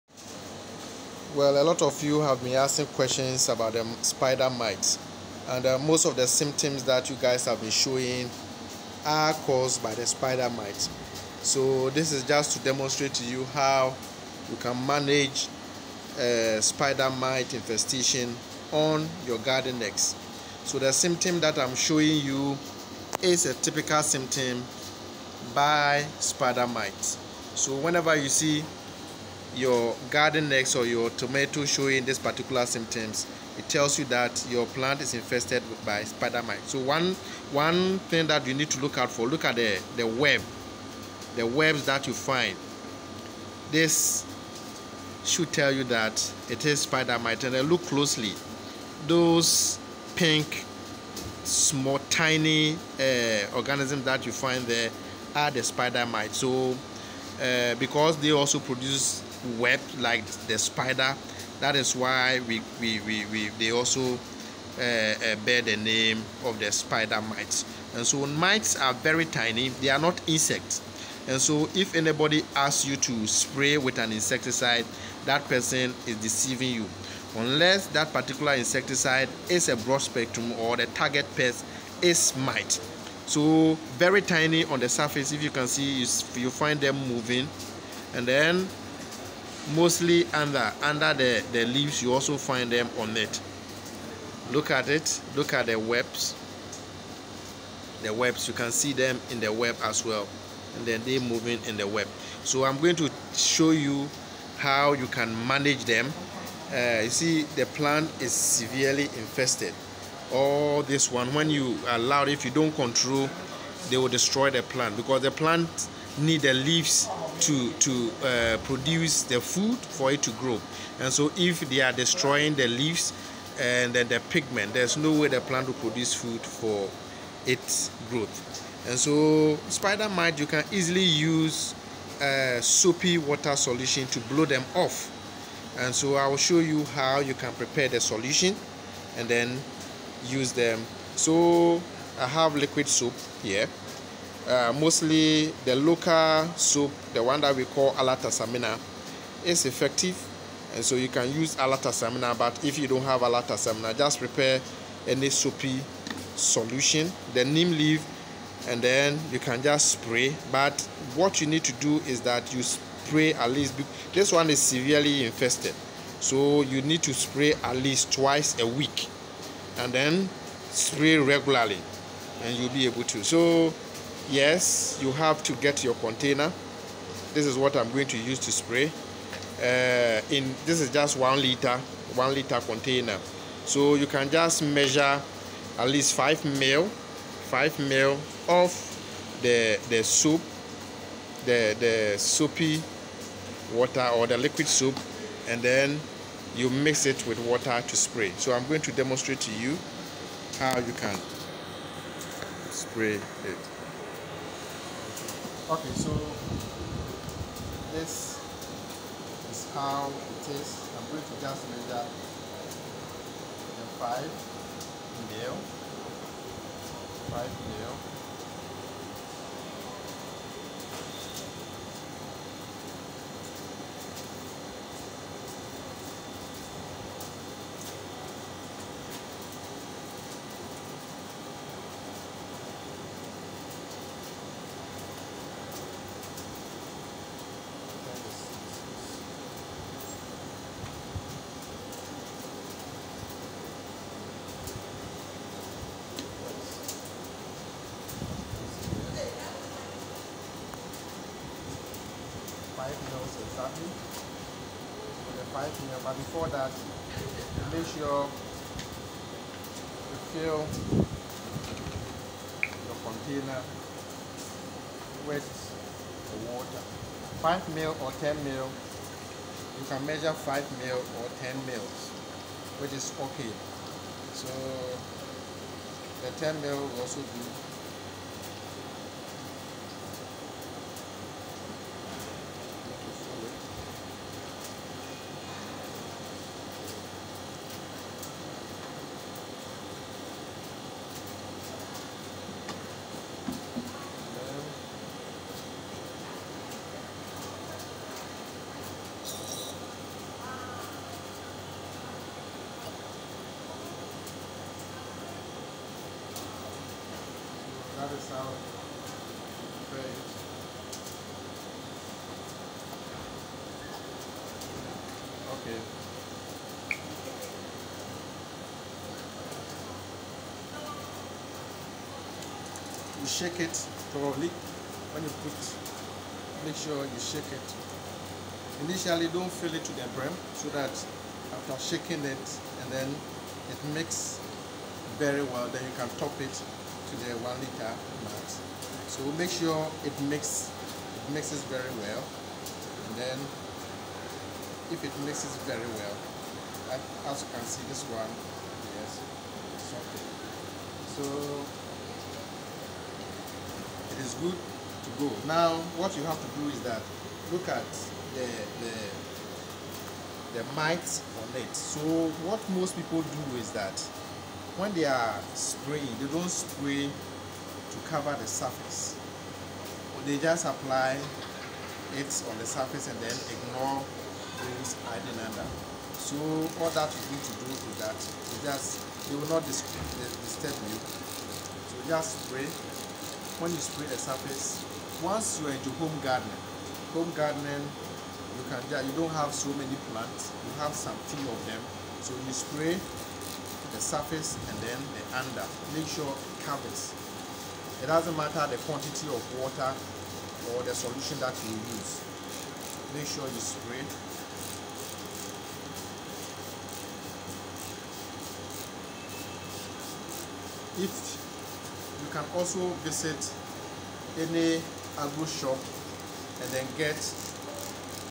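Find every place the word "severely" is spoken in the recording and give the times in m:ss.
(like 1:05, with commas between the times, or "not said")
1:48, 2:44.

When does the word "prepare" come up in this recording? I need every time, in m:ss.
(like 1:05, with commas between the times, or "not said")
2:17, 2:34.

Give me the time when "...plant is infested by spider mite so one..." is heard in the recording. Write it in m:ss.
0:34.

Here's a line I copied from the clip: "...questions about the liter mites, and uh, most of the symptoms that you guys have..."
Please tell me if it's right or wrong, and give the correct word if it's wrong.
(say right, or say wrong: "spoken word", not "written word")
wrong: "spider", not "liter".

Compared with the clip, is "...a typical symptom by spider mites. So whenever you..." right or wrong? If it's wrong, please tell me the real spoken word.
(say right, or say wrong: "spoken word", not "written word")
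right.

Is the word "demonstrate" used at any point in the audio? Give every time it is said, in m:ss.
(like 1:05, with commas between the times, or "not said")
0:12, 3:18.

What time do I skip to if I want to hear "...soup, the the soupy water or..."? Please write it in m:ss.
3:10.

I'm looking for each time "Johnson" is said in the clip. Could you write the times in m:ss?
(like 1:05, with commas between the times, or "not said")
not said.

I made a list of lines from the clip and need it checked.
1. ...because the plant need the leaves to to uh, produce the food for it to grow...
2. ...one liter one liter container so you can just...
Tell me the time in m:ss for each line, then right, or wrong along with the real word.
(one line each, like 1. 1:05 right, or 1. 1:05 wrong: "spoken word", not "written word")
1. 1:54 right
2. 3:01 right.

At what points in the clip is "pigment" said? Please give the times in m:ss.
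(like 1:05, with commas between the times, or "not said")
2:04.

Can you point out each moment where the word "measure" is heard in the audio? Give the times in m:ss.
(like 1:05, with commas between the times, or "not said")
3:04, 3:31, 4:30.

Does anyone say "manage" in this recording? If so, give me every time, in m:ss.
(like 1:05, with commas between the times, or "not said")
0:14, 1:45.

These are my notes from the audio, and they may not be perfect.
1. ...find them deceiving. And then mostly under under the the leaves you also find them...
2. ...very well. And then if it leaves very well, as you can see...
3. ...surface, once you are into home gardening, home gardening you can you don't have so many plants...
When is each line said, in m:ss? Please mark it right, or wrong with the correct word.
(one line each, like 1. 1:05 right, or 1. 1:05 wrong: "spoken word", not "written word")
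1. 1:26 wrong: "moving", not "deceiving"
2. 5:41 wrong: "mixes", not "leaves"
3. 6:24 right.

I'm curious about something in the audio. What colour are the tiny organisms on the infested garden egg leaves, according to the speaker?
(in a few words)
pink.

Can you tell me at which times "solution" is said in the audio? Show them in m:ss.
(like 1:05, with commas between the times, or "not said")
2:13, 2:17, 2:36, 6:40.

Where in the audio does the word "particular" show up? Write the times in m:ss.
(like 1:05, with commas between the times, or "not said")
0:32, 1:18.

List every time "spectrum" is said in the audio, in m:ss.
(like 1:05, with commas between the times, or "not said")
1:19.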